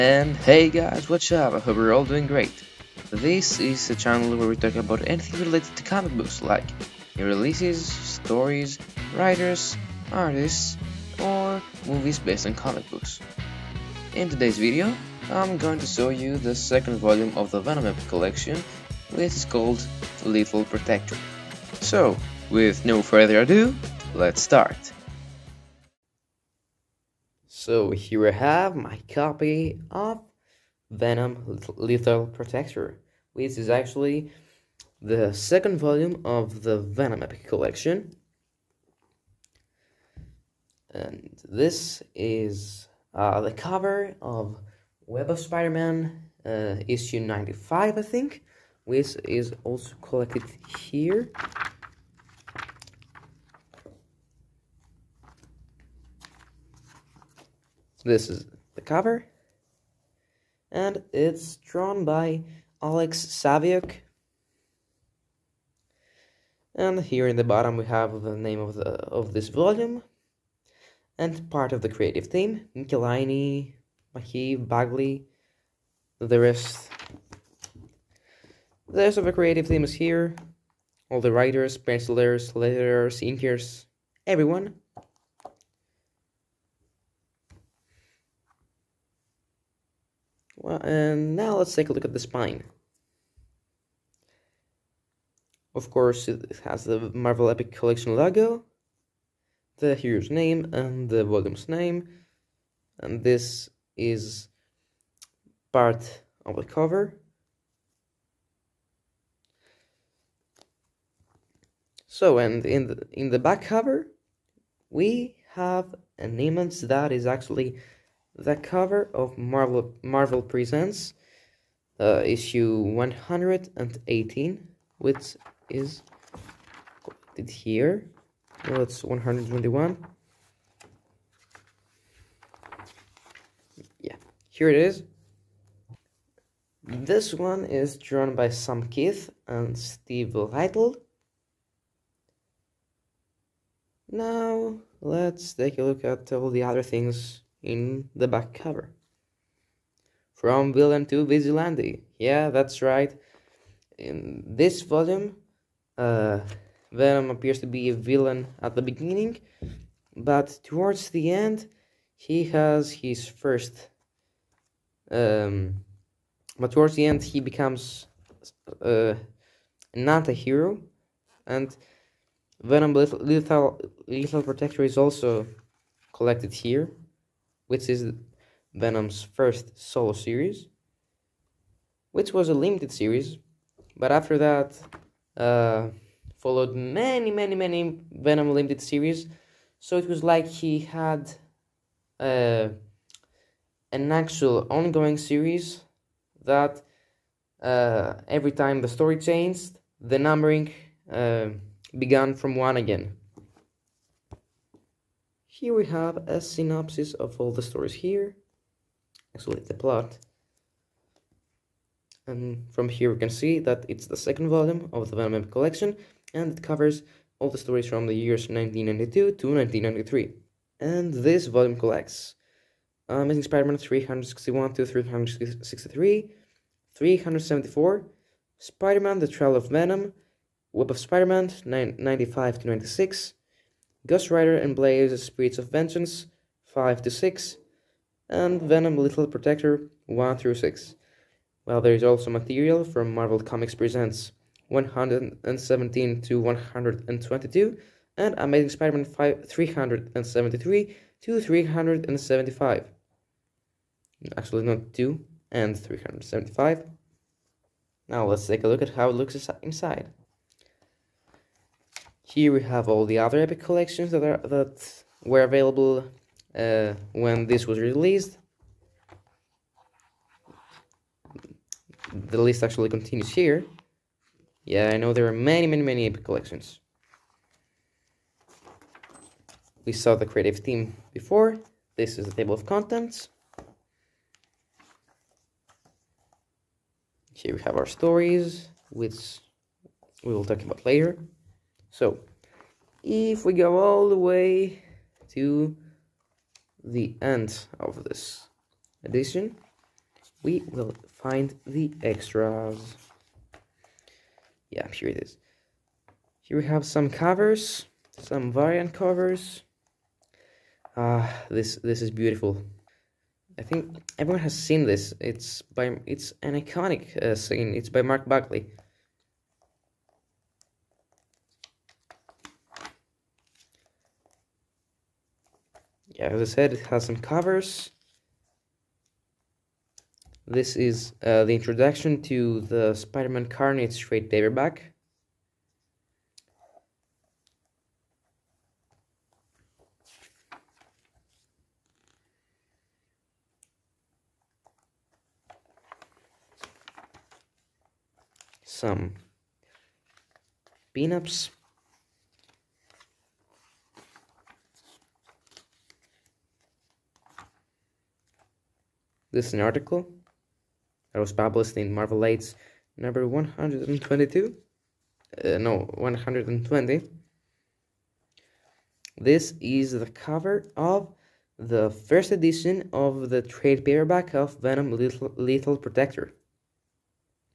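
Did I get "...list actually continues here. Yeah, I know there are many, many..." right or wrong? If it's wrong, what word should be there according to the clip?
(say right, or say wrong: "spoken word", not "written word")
right.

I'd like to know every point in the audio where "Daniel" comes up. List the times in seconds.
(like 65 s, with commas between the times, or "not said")
not said.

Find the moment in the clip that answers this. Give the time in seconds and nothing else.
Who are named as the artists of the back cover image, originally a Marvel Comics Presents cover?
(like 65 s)
138 s.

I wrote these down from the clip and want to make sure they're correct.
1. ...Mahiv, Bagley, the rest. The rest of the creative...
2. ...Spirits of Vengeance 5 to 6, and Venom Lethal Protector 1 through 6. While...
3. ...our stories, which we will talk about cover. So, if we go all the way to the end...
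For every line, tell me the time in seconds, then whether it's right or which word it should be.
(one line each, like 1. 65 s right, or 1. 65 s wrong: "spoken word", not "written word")
1. 74 s right
2. 235 s right
3. 287 s wrong: "later", not "cover".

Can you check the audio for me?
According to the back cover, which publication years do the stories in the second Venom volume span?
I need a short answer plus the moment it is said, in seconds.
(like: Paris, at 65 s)
1992 to 1993, at 218 s.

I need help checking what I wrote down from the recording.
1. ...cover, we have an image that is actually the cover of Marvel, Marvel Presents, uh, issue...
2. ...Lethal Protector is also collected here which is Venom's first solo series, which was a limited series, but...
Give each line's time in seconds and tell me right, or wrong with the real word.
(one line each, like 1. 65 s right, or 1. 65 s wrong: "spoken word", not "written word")
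1. 113 s right
2. 174 s right.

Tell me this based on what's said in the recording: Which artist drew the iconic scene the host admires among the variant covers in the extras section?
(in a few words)
Mark Bagley.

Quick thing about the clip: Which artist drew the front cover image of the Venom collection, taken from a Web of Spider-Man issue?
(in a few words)
Alex Saviuk.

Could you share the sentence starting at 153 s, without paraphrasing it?
In this volume, uh, Venom appears to be a villain at the beginning, but towards the end, he has his first.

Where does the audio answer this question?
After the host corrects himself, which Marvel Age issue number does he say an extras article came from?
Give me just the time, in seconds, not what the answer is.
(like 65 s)
365 s.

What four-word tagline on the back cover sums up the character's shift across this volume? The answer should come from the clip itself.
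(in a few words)
From villain to vigilante.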